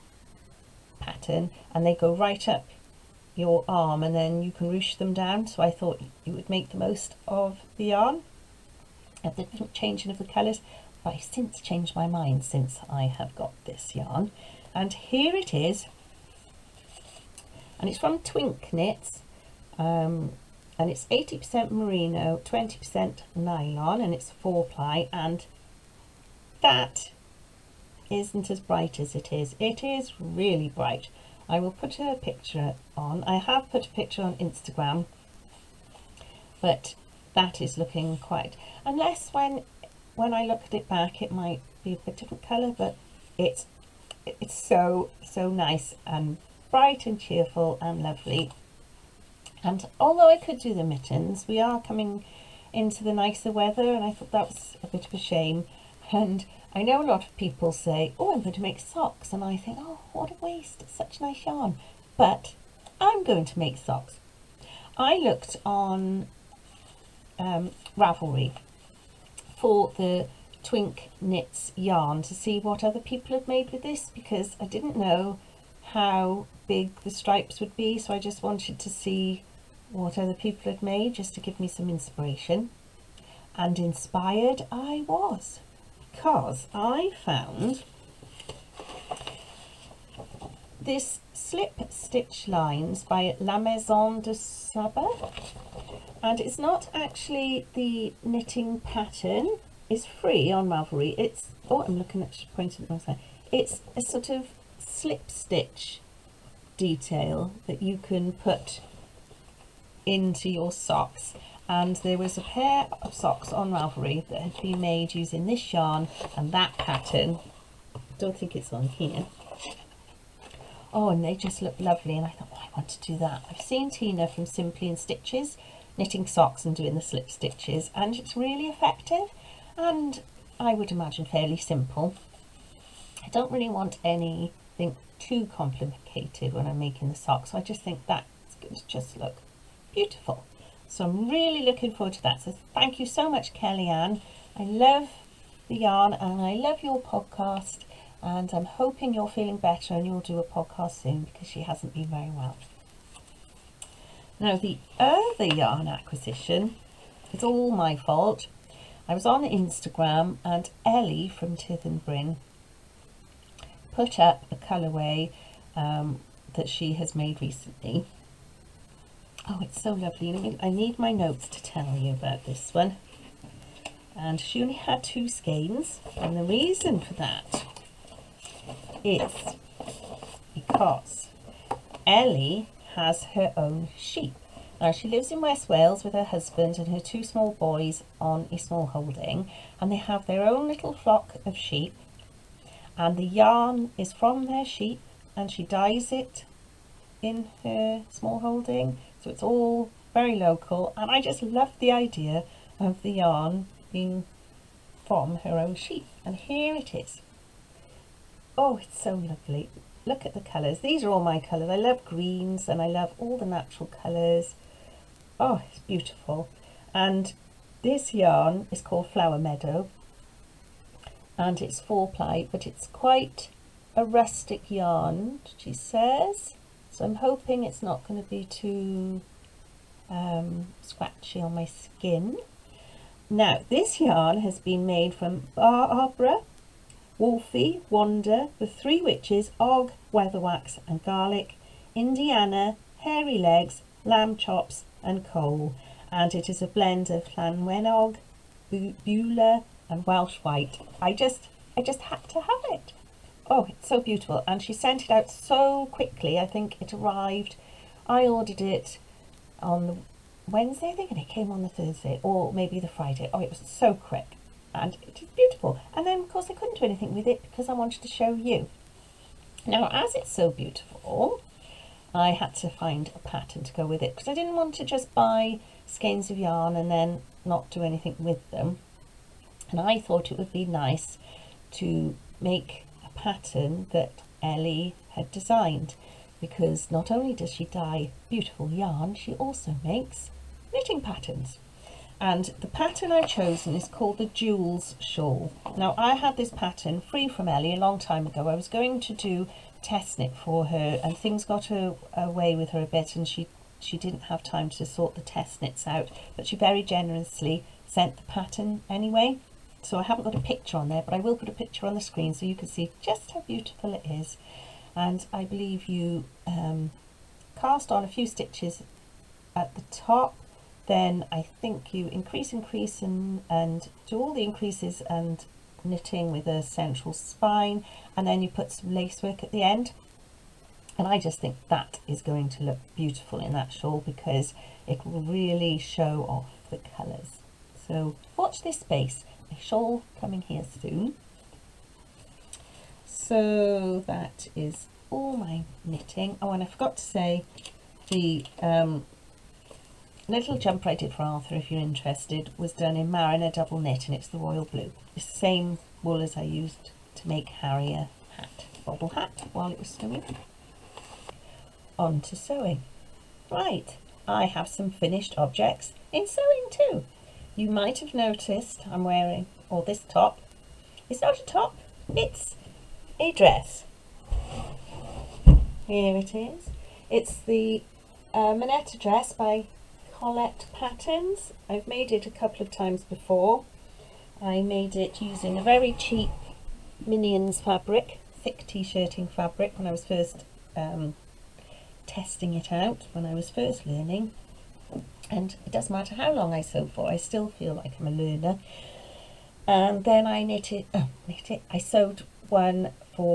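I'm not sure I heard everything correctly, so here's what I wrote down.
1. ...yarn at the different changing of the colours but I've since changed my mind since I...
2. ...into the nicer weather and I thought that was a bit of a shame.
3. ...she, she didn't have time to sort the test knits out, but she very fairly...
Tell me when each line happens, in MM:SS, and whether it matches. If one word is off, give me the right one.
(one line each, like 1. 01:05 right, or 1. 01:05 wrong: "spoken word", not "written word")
1. 00:07 right
2. 00:52 right
3. 05:03 wrong: "generously", not "fairly".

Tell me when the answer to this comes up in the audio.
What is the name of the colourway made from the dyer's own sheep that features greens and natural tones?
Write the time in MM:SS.
03:39.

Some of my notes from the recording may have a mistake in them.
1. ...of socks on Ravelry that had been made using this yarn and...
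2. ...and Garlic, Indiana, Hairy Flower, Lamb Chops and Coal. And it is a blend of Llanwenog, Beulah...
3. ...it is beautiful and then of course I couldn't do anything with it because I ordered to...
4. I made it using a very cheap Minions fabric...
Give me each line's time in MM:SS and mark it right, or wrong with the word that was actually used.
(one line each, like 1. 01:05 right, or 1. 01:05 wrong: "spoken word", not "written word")
1. 01:53 right
2. 04:00 wrong: "Legs", not "Flower"
3. 04:25 wrong: "wanted", not "ordered"
4. 06:24 right.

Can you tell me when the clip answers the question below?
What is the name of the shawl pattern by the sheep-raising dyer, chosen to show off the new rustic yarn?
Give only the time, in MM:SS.
04:54.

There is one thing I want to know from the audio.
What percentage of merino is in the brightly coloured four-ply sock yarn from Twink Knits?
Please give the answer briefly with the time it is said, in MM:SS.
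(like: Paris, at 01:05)
80% merino, at 00:21.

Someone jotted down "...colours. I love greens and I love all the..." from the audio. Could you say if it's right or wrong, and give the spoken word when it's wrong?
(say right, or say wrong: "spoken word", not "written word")
right.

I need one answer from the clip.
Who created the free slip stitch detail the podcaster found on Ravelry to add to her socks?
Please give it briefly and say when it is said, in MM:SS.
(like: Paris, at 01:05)
La Maison de Saba, at 01:33.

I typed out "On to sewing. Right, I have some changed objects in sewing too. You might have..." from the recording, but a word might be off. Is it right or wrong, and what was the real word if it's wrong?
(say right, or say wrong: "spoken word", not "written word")
wrong: "finished", not "changed".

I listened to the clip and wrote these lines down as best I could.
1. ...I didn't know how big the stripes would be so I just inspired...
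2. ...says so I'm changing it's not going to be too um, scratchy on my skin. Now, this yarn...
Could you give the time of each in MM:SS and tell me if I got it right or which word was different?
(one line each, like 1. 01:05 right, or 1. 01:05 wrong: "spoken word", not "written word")
1. 01:14 wrong: "wanted", not "inspired"
2. 03:45 wrong: "hoping", not "changing".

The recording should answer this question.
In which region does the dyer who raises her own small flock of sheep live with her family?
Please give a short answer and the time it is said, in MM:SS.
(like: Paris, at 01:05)
West Wales, at 03:05.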